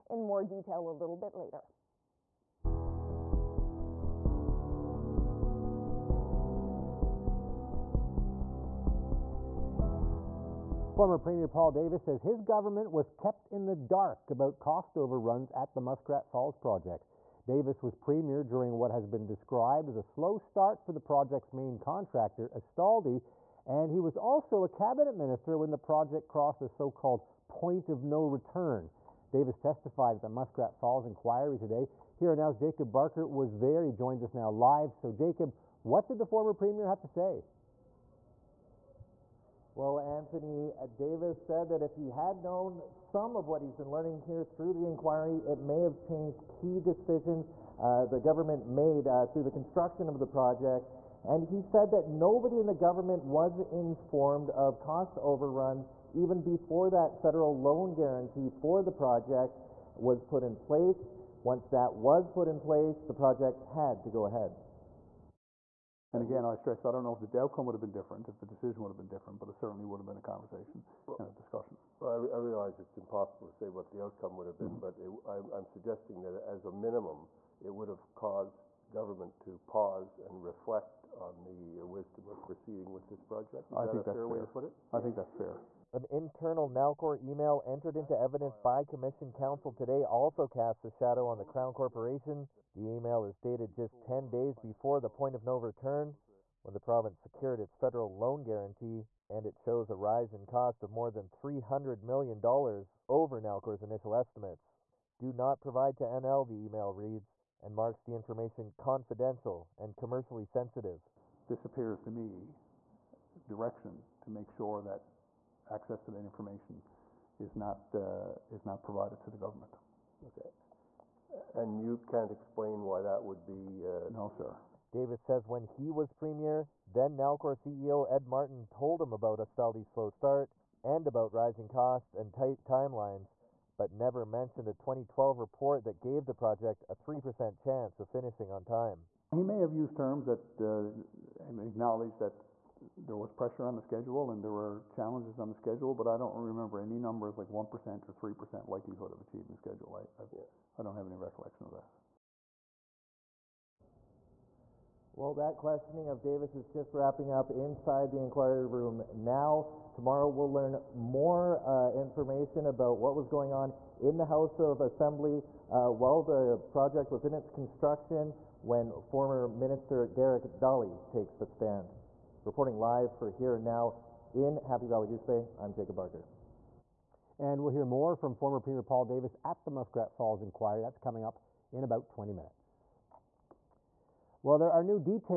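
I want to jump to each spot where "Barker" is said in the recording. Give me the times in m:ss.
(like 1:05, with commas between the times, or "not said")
0:32, 2:55.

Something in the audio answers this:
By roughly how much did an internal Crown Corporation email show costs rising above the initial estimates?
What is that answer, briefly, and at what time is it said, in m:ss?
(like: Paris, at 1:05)
more than $300 million, at 1:40.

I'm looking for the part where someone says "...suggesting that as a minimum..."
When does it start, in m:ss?
1:15.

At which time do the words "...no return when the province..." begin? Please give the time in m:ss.
1:35.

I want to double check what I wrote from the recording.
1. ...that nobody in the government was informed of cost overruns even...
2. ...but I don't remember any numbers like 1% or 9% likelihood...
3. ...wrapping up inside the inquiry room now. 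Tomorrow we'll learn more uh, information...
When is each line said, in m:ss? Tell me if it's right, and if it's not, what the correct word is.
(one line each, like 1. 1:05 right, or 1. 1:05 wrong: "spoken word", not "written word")
1. 0:51 right
2. 2:25 wrong: "3", not "9"
3. 2:36 right.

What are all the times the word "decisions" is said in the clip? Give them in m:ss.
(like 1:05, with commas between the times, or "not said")
0:46, 1:08.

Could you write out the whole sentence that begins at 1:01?
Once that was put in place, the project had to go ahead.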